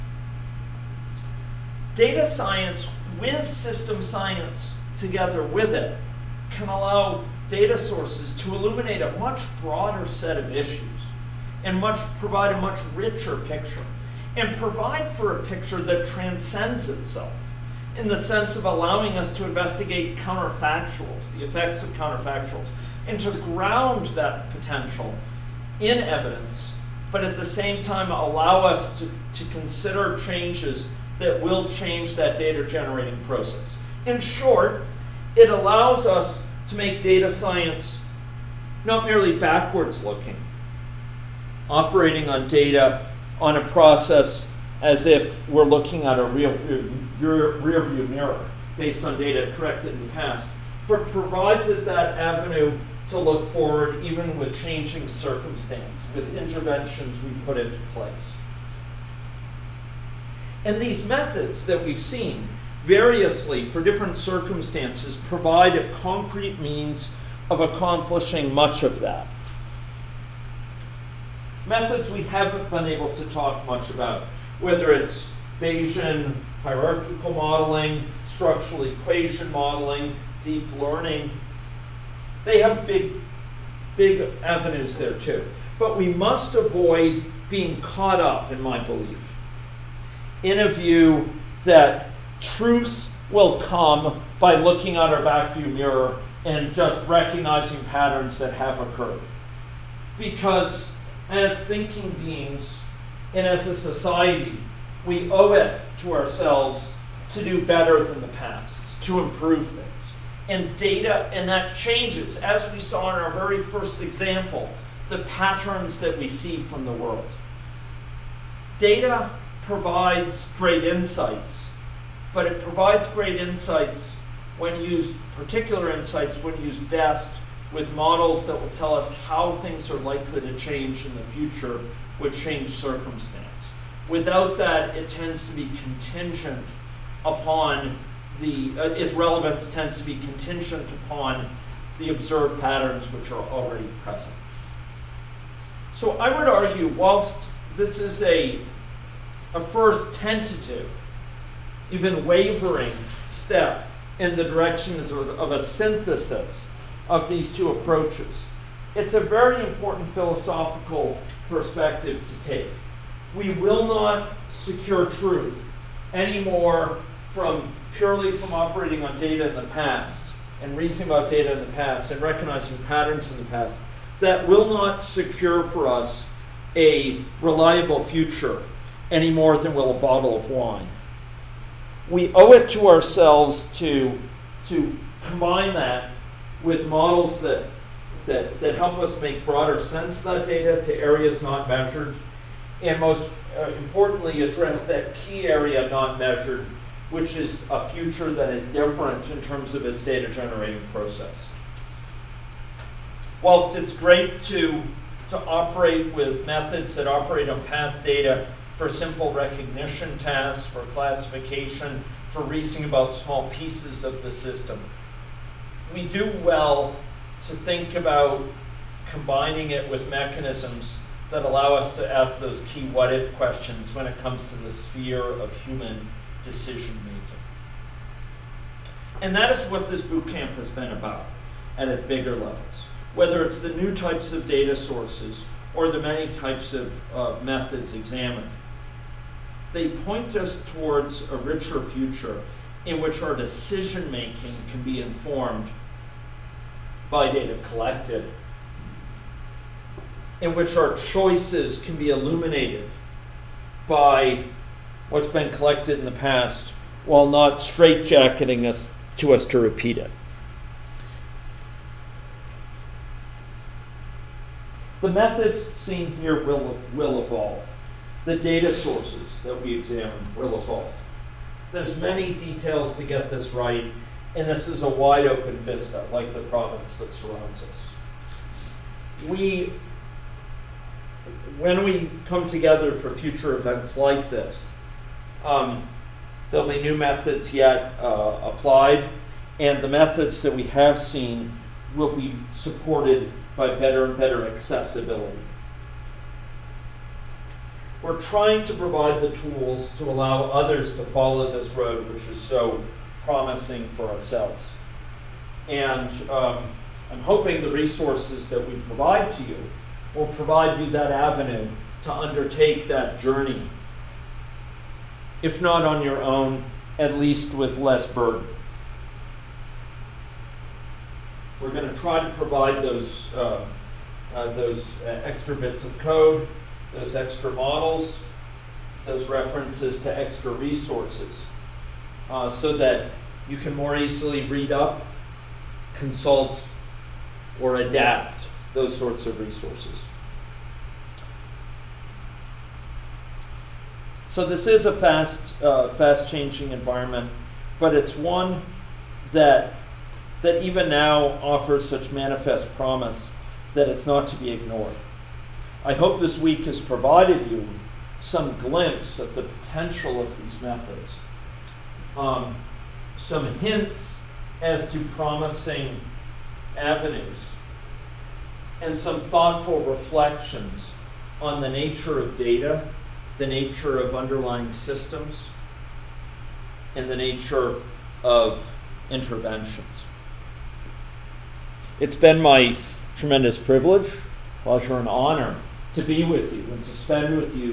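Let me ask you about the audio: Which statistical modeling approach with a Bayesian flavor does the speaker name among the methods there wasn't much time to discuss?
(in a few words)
Bayesian hierarchical modeling.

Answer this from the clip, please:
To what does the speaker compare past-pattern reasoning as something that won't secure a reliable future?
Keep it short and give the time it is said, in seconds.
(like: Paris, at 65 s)
A bottle of wine, at 179 s.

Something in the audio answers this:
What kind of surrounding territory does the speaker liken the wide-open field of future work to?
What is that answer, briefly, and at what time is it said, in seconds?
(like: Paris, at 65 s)
The province, at 276 s.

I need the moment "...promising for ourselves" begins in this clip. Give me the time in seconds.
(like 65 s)
303 s.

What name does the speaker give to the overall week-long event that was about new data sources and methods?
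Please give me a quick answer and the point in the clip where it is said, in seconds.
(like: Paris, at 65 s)
Boot camp, at 230 s.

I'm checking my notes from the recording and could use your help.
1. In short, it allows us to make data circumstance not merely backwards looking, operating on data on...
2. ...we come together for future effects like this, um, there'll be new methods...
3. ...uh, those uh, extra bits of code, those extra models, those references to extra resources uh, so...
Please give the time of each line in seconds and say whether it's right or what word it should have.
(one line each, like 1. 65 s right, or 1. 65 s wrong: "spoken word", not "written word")
1. 34 s wrong: "science", not "circumstance"
2. 281 s wrong: "events", not "effects"
3. 324 s right.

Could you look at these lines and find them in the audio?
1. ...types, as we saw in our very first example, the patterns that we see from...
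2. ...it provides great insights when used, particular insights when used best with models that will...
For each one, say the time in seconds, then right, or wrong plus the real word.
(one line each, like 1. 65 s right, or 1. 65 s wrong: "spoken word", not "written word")
1. 111 s wrong: "changes", not "types"
2. 122 s right.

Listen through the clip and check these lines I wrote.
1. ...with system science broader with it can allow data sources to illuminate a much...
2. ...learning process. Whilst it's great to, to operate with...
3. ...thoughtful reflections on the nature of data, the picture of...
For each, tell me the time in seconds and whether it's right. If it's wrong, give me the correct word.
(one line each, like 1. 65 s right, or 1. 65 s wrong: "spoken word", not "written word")
1. 3 s wrong: "together", not "broader"
2. 200 s wrong: "generating", not "learning"
3. 369 s wrong: "nature", not "picture".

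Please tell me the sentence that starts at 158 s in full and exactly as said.
It's a very important philosophical perspective to take.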